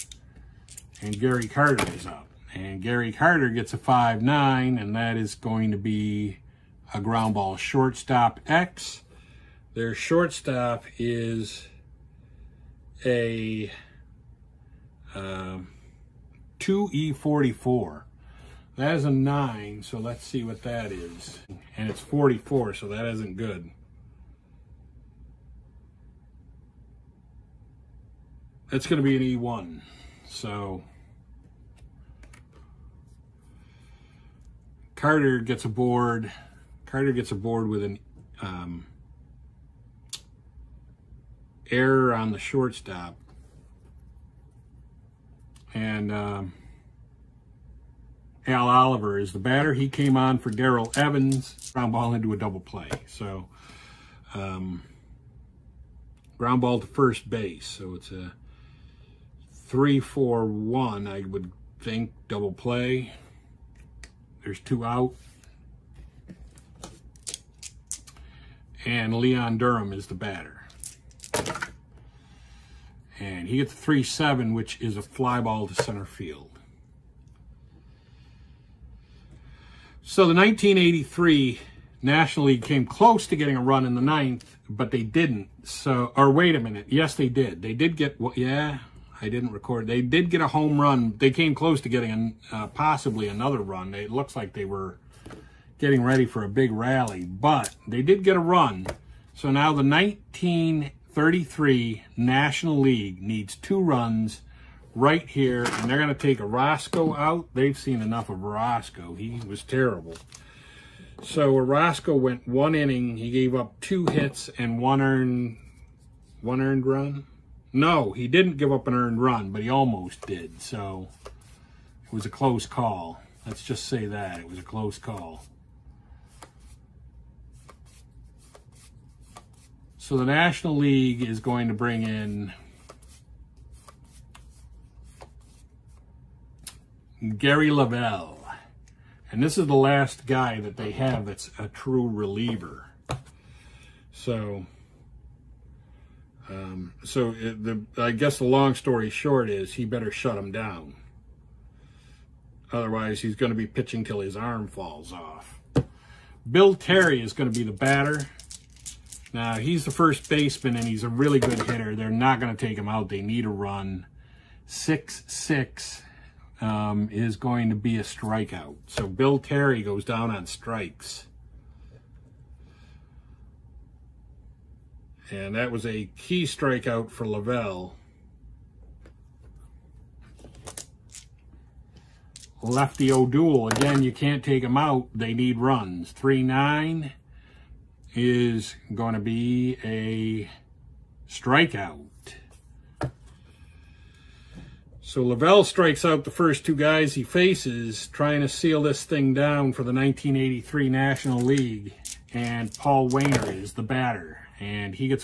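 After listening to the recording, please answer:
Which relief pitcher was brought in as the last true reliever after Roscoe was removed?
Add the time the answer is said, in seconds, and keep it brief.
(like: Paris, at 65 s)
Gary Lavelle, at 137 s.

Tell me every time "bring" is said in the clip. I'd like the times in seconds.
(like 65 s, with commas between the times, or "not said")
131 s.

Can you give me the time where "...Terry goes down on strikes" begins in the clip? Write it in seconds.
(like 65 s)
169 s.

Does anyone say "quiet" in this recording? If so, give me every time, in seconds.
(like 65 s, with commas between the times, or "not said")
not said.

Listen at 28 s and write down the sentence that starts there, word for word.
That's going to be an E1.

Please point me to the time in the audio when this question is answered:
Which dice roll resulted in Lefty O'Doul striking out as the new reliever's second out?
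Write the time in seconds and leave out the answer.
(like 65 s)
186 s.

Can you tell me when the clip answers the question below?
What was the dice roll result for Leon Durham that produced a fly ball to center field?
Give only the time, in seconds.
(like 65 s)
73 s.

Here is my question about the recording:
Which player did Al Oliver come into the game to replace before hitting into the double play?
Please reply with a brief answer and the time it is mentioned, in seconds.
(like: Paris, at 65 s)
Darrell Evans, at 50 s.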